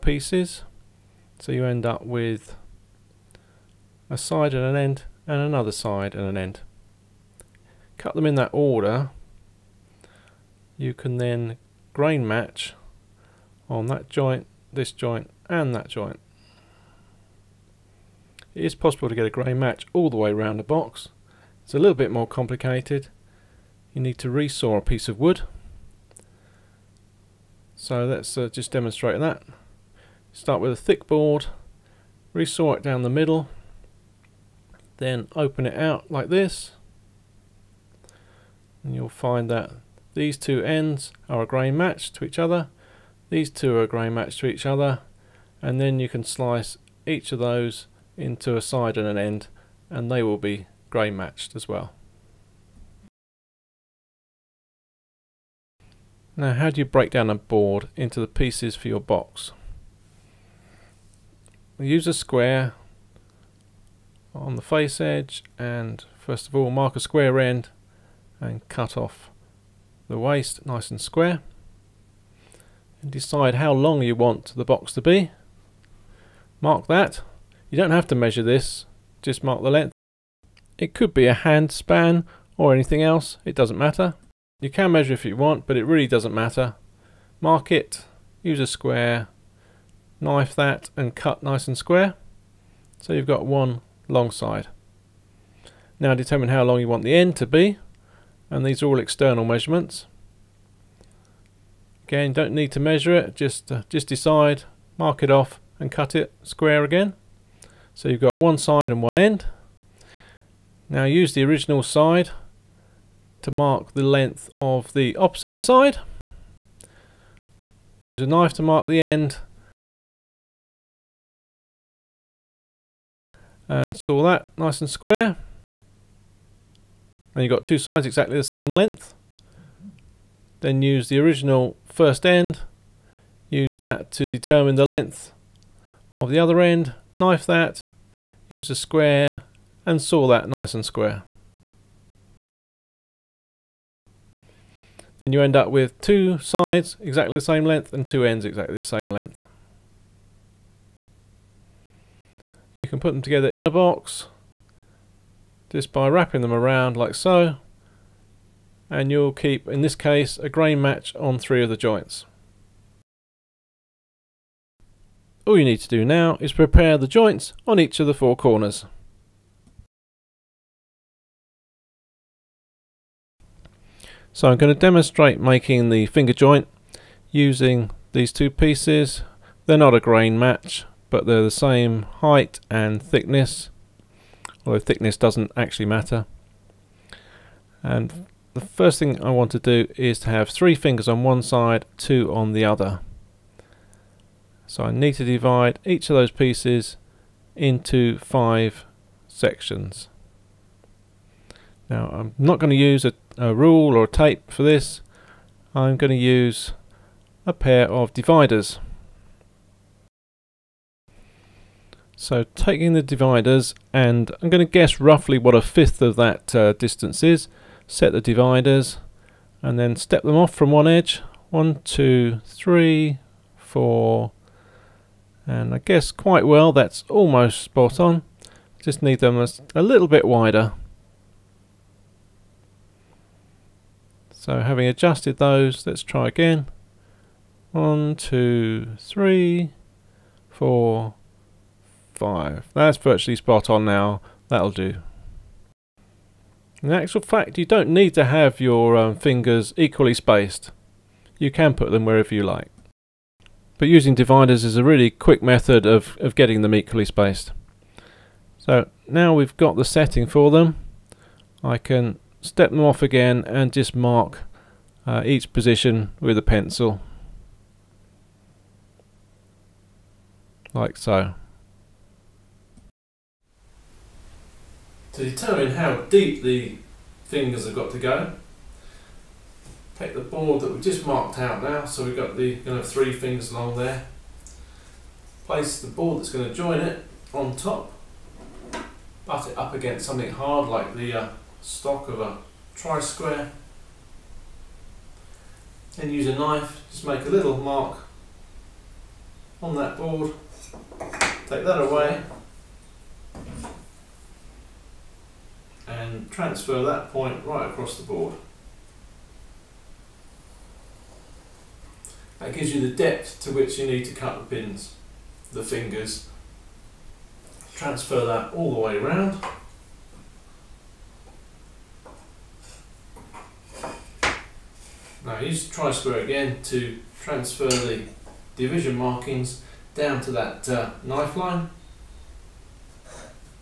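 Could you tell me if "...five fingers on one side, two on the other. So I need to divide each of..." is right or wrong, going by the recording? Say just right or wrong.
wrong.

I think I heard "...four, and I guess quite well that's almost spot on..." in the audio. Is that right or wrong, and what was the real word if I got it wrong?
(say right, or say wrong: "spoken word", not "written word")
right.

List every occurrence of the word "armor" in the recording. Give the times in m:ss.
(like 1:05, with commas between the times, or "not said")
not said.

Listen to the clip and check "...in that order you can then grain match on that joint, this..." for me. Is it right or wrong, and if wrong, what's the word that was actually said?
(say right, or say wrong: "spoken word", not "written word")
right.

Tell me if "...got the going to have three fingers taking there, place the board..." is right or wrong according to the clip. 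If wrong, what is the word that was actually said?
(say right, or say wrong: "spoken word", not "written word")
wrong: "along", not "taking".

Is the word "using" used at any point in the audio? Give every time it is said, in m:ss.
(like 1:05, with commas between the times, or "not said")
2:57, 4:13.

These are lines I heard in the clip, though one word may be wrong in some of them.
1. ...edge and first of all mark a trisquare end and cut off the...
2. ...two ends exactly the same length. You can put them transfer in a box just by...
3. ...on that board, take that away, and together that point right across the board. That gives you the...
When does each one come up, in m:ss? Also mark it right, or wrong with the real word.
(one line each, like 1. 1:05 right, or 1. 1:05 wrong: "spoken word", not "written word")
1. 1:05 wrong: "square", not "trisquare"
2. 2:28 wrong: "together", not "transfer"
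3. 4:59 wrong: "transfer", not "together".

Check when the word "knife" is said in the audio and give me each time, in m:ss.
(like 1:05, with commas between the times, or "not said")
1:30, 1:58, 2:17, 4:56, 5:31.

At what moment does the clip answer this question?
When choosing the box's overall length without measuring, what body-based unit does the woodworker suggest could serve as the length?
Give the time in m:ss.
1:21.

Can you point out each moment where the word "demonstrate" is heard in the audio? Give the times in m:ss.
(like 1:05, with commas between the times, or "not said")
0:28, 2:54.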